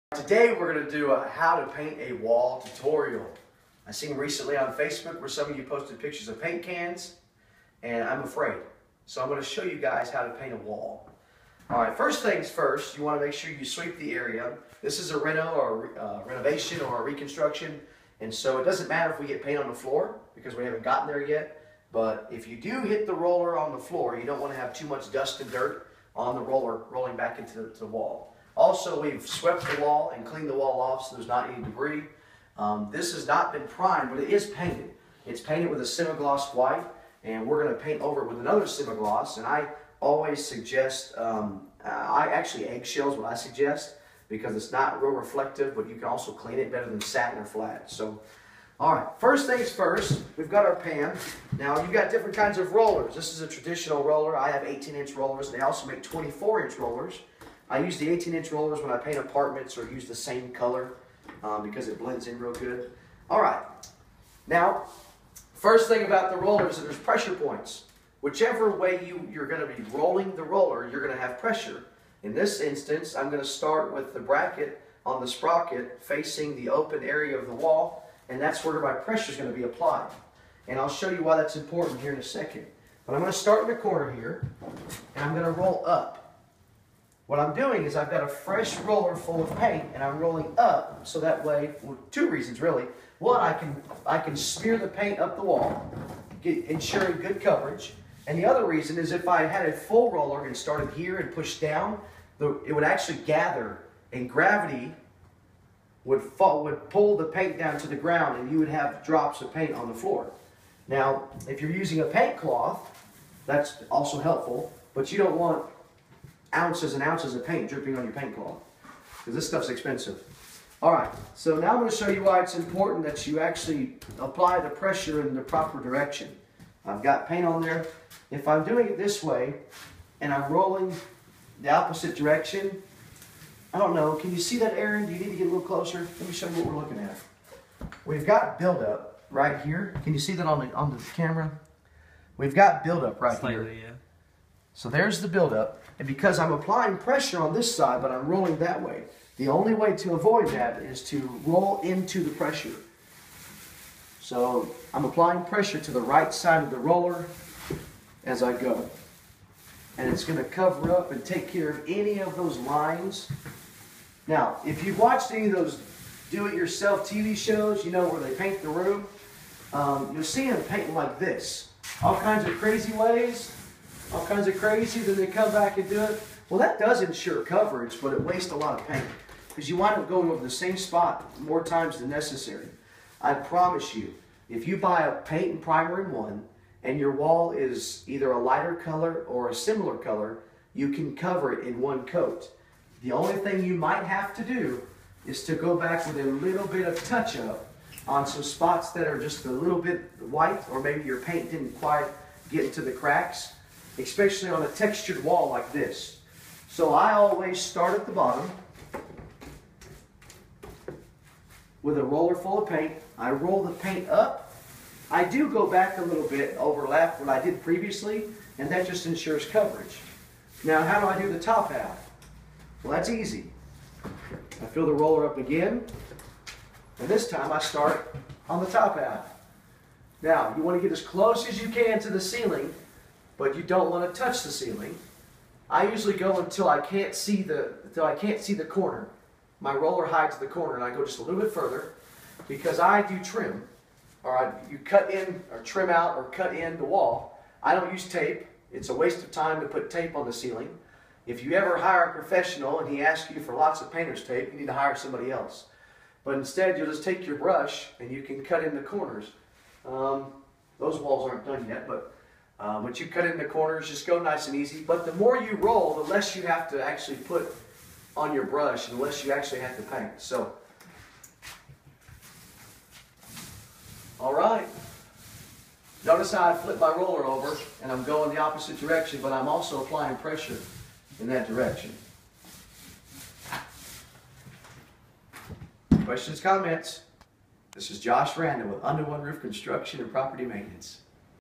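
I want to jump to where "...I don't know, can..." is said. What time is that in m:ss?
2:13.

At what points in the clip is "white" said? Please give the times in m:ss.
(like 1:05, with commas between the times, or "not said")
0:36, 3:20.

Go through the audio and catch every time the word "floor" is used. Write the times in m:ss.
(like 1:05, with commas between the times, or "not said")
0:19, 0:23, 1:49.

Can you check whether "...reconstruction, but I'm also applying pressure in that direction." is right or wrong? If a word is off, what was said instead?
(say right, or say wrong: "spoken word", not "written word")
wrong: "direction", not "reconstruction".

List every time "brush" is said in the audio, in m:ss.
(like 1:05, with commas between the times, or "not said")
4:17, 4:28.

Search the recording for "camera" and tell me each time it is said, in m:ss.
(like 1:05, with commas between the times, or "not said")
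2:21.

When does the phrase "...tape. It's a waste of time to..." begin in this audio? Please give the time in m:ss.
4:08.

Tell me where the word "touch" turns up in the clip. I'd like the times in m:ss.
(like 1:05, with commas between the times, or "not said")
3:17, 3:54.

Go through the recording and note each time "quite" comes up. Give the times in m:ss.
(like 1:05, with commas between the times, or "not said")
3:21.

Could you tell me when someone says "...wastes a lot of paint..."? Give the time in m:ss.
2:58.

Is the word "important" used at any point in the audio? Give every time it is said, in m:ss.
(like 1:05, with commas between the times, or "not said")
1:21, 2:02.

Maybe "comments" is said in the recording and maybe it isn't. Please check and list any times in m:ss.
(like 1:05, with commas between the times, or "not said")
4:46.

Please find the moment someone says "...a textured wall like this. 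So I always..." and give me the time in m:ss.
3:24.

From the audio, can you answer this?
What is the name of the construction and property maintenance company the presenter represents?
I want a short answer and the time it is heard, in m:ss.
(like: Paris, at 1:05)
Under One Roof, at 4:48.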